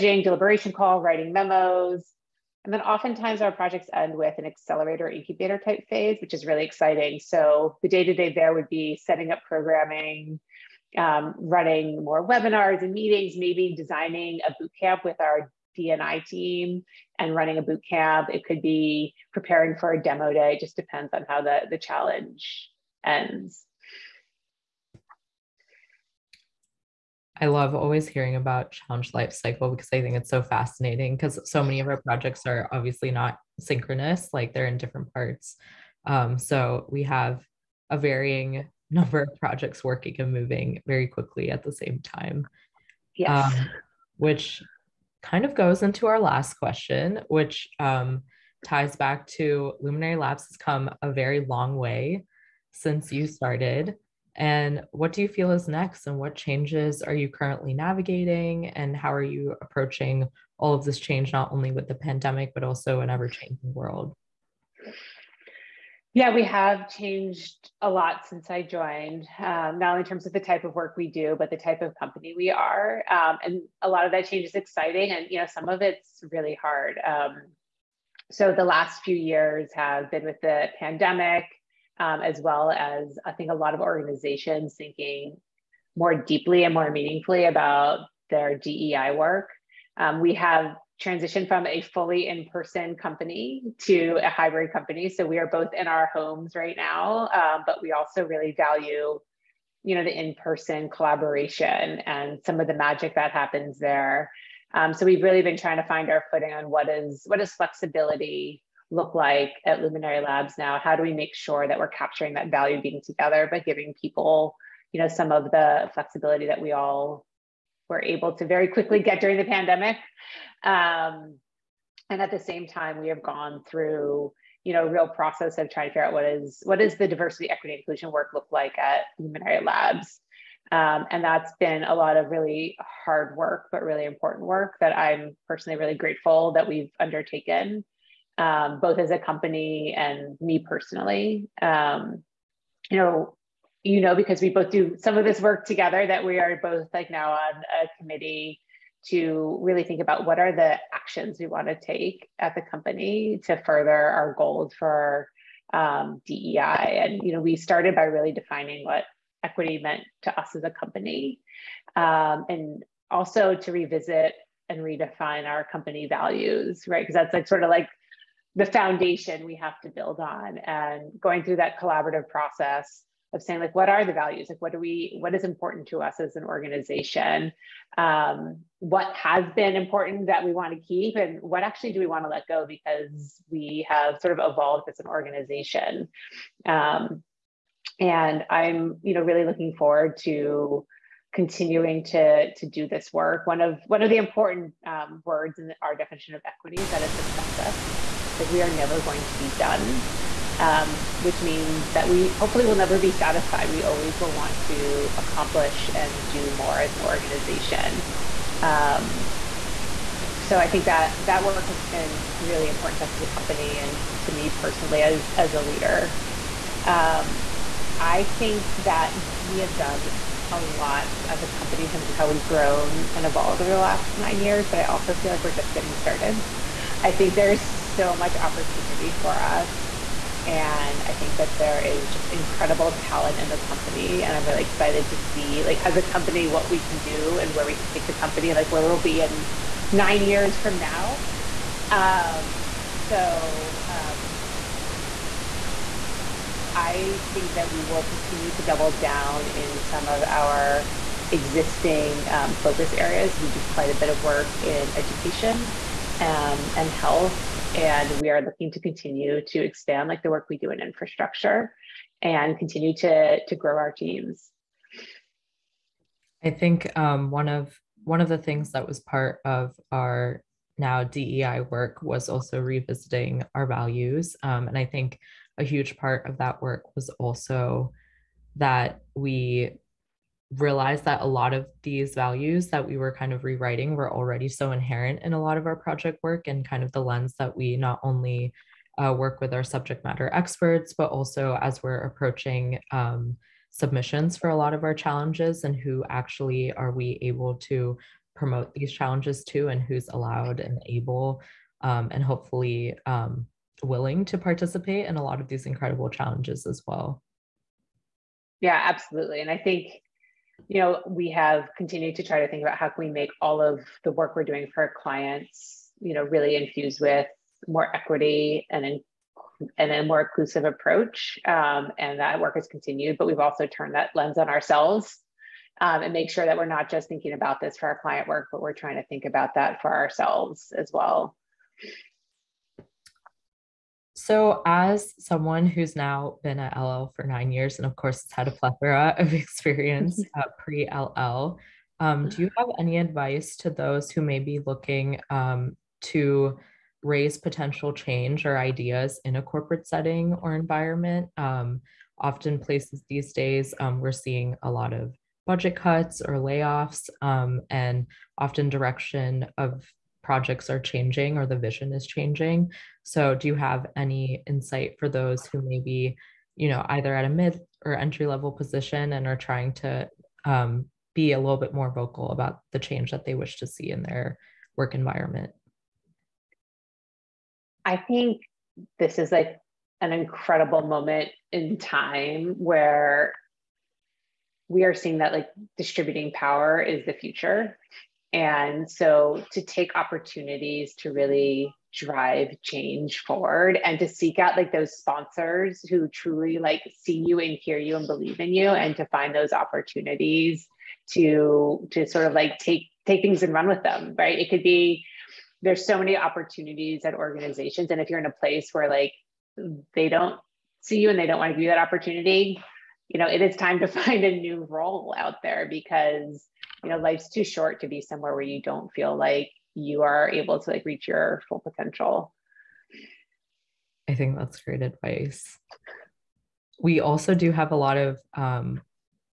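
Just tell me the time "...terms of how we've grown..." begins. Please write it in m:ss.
3:41.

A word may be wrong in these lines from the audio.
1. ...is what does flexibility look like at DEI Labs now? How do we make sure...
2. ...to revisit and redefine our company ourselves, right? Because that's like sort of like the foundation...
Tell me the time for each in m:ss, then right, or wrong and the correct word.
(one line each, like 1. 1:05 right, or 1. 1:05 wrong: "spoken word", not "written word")
1. 1:46 wrong: "Luminary", not "DEI"
2. 2:43 wrong: "values", not "ourselves".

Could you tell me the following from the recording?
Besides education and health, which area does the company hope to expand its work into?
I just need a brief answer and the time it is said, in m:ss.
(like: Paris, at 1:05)
infrastructure, at 4:20.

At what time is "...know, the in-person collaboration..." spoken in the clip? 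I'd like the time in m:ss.
1:39.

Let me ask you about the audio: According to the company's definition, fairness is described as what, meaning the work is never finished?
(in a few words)
a process.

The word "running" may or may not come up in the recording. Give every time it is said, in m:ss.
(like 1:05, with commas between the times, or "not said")
0:11, 0:17.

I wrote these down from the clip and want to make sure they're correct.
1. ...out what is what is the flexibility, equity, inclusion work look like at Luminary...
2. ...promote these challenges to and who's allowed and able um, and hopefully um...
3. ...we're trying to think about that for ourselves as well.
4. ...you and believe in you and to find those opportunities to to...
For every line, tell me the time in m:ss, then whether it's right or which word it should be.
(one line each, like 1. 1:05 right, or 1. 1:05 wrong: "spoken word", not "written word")
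1. 2:06 wrong: "diversity", not "flexibility"
2. 4:58 right
3. 5:28 right
4. 6:37 right.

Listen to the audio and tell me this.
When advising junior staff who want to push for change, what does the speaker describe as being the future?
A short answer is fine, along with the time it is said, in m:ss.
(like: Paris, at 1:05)
distributing power, at 6:25.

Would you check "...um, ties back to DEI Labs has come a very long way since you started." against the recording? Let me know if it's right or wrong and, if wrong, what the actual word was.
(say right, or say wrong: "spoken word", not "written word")
wrong: "Luminary", not "DEI".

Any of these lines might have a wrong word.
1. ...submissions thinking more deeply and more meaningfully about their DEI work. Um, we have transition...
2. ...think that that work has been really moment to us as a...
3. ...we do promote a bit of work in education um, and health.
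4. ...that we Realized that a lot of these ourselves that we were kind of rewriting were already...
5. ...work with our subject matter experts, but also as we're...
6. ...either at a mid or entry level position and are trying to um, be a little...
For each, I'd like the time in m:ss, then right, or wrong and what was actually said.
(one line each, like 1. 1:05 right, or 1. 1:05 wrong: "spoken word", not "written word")
1. 1:23 wrong: "organizations", not "submissions"
2. 3:30 wrong: "important", not "moment"
3. 4:13 wrong: "quite", not "promote"
4. 4:38 wrong: "values", not "ourselves"
5. 4:49 right
6. 6:06 right.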